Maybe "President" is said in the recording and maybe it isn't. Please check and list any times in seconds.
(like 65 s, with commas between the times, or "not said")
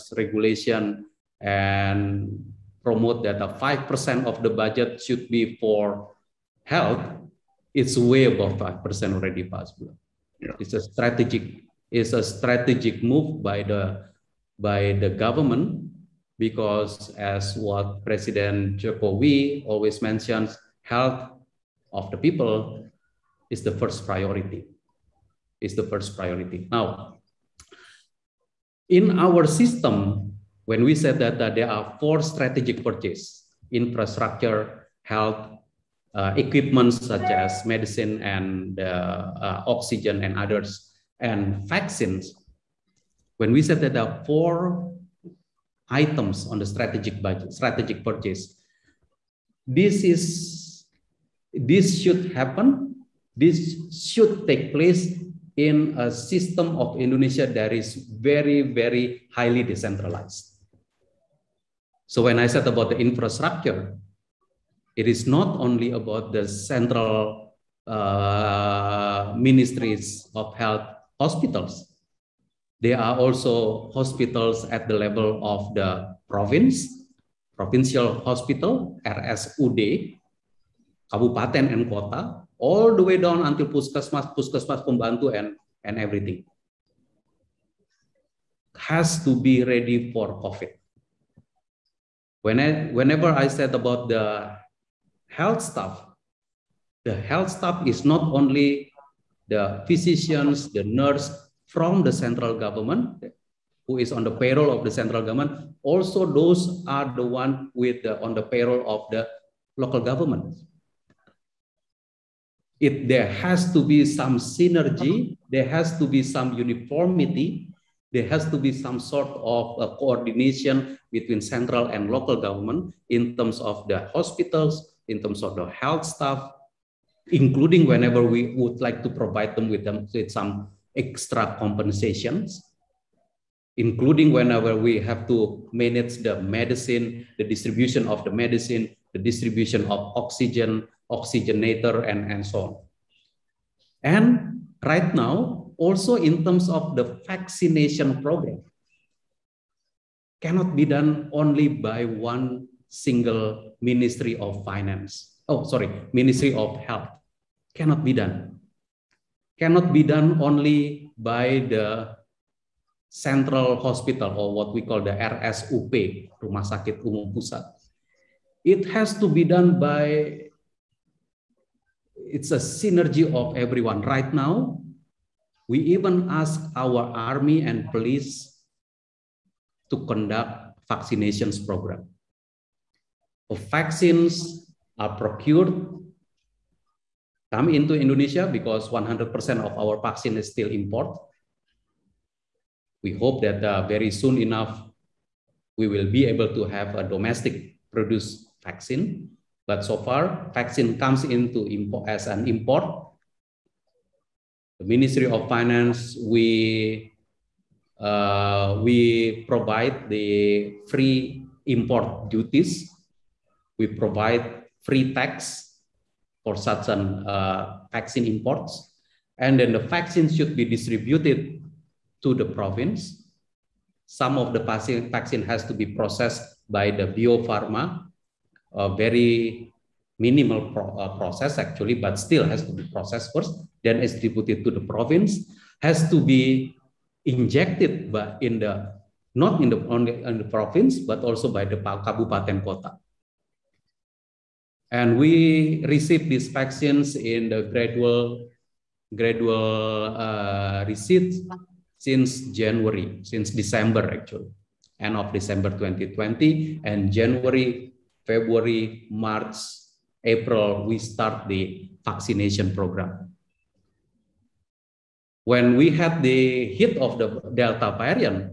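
18 s.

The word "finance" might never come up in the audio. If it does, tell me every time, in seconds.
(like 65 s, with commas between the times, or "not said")
154 s, 205 s.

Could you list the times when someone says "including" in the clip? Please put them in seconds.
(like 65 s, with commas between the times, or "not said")
127 s, 133 s.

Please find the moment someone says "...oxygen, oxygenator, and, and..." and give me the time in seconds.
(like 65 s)
140 s.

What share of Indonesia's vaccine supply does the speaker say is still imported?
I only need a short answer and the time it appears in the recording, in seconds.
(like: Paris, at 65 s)
100%, at 188 s.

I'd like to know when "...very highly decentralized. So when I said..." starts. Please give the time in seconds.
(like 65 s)
58 s.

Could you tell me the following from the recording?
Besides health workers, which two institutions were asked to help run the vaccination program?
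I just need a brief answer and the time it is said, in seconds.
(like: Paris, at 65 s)
army and police, at 177 s.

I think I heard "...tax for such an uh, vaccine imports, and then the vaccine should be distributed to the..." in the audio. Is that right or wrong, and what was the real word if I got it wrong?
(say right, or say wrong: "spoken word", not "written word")
right.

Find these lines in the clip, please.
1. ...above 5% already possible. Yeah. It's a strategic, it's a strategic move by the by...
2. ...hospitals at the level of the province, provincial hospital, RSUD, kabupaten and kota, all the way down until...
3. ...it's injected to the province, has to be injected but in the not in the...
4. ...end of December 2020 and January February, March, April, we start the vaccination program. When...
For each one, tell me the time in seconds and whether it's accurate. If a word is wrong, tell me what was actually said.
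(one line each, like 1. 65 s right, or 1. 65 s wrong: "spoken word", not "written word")
1. 8 s right
2. 73 s right
3. 234 s wrong: "distributed", not "injected"
4. 255 s right.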